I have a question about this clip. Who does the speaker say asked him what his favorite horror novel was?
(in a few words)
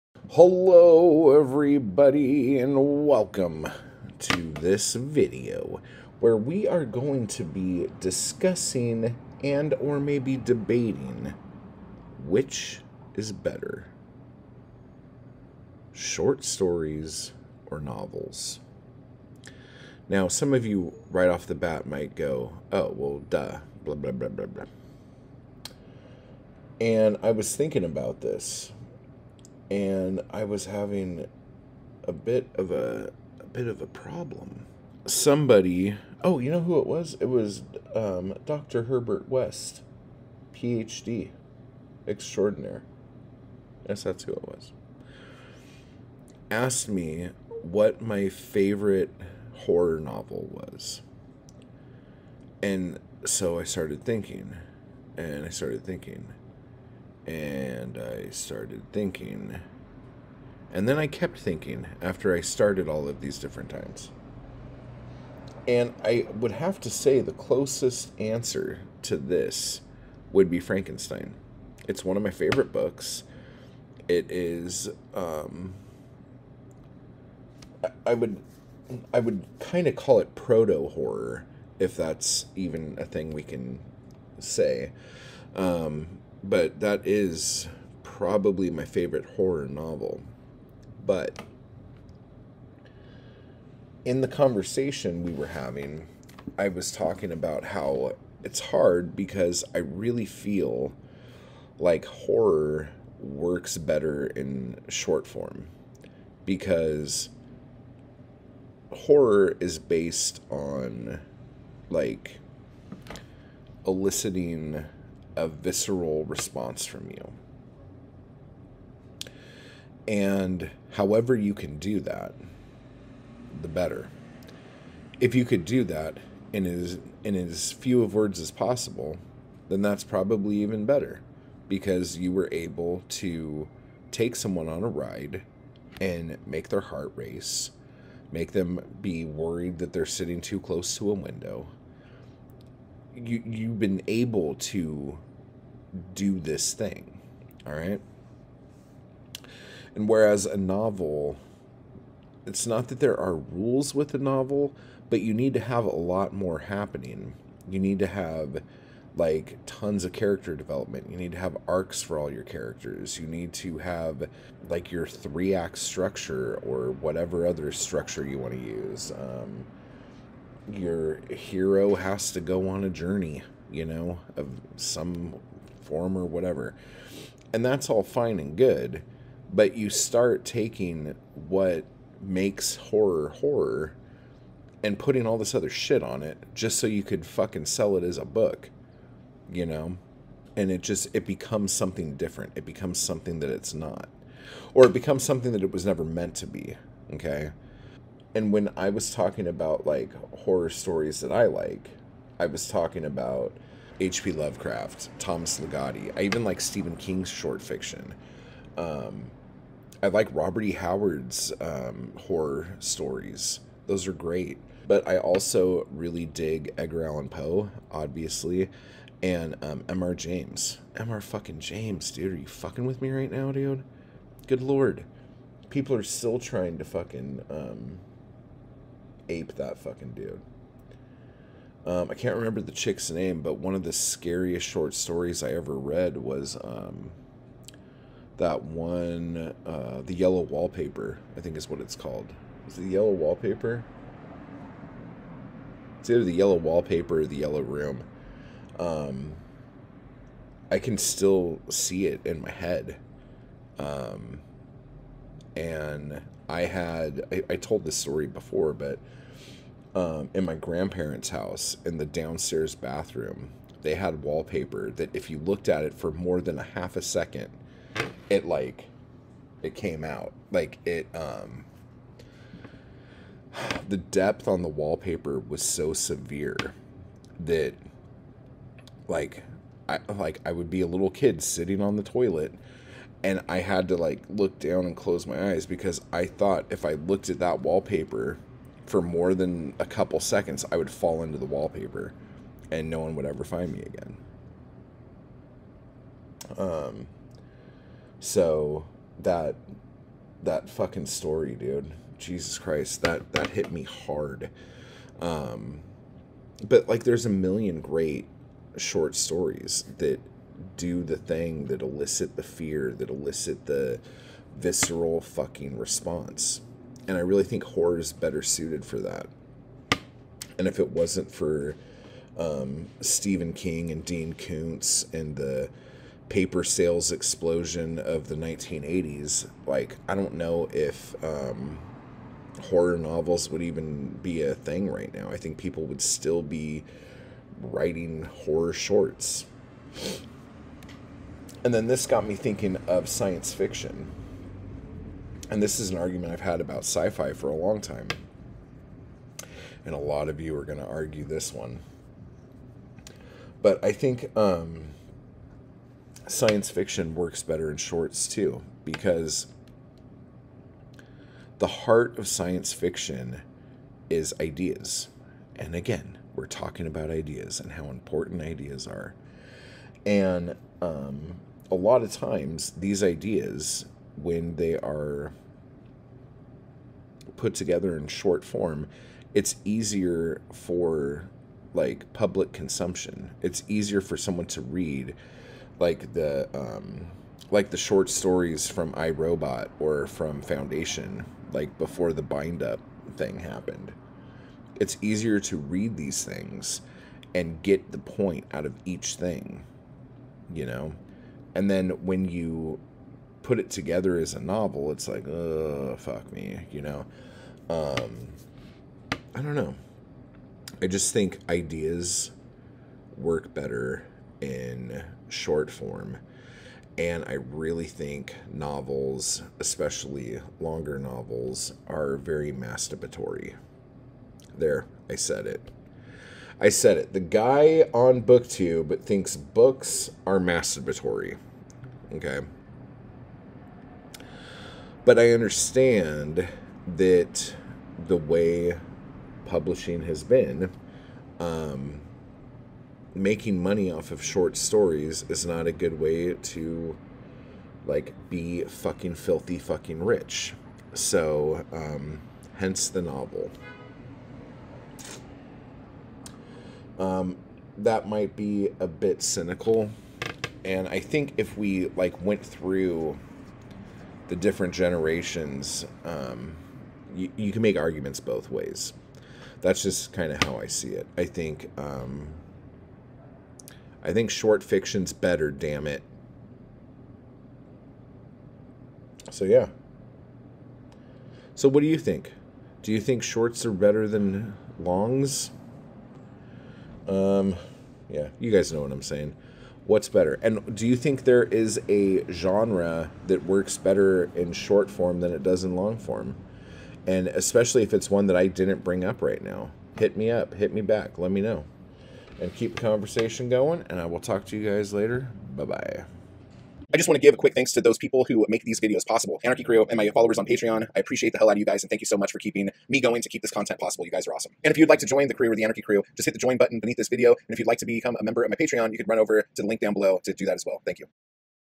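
Dr. Herbert West.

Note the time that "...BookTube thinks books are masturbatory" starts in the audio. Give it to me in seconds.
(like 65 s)
428 s.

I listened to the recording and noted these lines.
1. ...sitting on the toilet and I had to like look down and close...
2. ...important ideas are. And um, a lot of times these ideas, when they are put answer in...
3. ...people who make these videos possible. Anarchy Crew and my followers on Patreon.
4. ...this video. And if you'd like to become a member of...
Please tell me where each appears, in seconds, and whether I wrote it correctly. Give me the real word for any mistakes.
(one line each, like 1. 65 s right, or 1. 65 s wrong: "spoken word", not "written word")
1. 281 s right
2. 367 s wrong: "together", not "answer"
3. 507 s right
4. 516 s right.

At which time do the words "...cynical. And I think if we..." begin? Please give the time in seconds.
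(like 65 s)
459 s.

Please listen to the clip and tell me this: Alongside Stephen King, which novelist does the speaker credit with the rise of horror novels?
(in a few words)
Dean Koontz.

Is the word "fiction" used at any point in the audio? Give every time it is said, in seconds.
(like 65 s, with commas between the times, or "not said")
207 s, 343 s, 356 s, 362 s, 474 s.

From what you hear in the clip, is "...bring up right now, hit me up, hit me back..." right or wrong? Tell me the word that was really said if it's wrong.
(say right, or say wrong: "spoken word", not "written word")
right.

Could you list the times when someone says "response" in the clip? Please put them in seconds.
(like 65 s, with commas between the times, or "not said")
116 s, 315 s.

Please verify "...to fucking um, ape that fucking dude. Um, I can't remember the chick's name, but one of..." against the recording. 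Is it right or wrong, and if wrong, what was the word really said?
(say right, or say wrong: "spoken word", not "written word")
right.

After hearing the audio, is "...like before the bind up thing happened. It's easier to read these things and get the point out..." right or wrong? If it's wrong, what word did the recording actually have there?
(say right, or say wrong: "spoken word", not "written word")
right.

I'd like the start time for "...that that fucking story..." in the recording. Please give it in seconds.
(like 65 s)
299 s.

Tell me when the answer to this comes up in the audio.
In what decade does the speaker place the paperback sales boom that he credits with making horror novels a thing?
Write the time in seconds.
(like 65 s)
328 s.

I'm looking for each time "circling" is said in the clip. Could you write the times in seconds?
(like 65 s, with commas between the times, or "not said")
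not said.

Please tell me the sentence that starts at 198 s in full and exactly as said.
and when I was talking about like horror stories that I like, I was talking about H.P.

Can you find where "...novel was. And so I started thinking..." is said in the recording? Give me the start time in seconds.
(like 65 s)
50 s.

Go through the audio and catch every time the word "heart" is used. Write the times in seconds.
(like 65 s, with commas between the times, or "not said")
136 s, 361 s.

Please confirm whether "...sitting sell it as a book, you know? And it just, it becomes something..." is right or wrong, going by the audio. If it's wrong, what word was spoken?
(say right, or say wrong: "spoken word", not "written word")
wrong: "fucking", not "sitting".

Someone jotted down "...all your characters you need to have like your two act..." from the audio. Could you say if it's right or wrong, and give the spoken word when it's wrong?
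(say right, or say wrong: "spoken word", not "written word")
wrong: "three", not "two".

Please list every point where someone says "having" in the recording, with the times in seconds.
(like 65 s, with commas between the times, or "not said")
30 s, 95 s.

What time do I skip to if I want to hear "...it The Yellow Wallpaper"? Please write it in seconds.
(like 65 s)
242 s.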